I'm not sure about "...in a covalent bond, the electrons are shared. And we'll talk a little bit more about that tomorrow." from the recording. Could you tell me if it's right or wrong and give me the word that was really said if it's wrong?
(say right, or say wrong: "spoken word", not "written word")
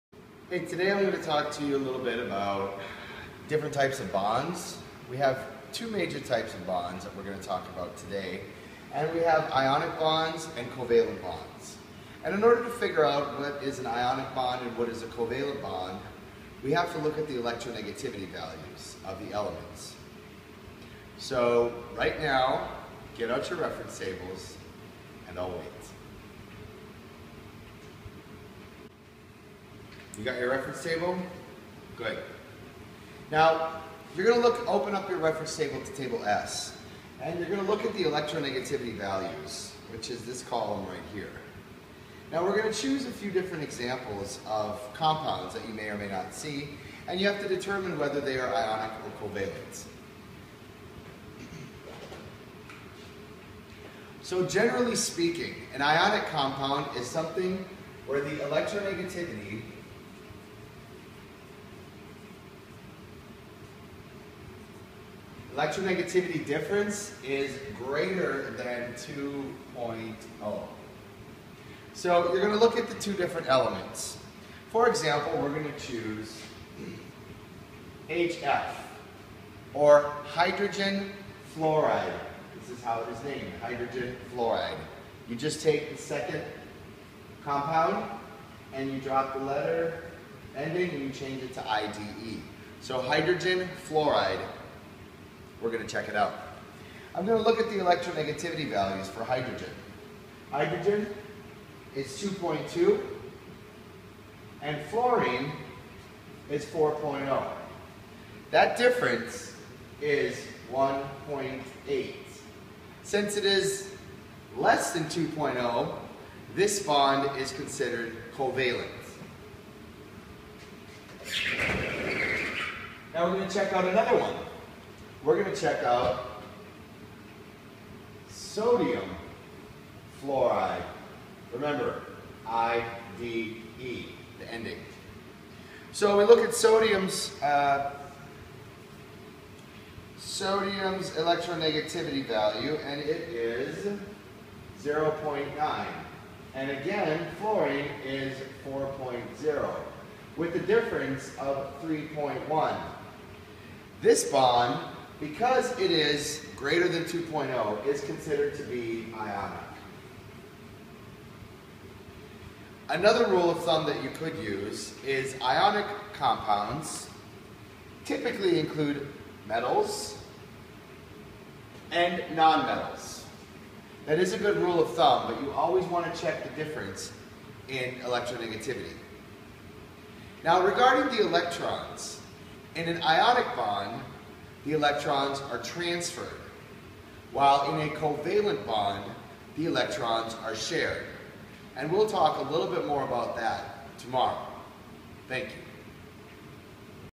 right.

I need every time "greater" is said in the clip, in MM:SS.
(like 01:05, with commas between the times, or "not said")
01:07, 02:36.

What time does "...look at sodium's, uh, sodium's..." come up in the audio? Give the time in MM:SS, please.
02:16.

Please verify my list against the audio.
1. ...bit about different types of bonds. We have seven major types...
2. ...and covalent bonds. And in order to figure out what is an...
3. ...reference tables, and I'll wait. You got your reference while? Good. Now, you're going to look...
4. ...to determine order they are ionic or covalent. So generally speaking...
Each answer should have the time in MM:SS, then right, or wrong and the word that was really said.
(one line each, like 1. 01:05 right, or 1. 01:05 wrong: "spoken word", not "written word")
1. 00:02 wrong: "two", not "seven"
2. 00:10 right
3. 00:23 wrong: "table", not "while"
4. 00:47 wrong: "whether", not "order".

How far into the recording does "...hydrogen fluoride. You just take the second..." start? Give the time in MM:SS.
01:23.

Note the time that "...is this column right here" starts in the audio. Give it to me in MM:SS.
00:40.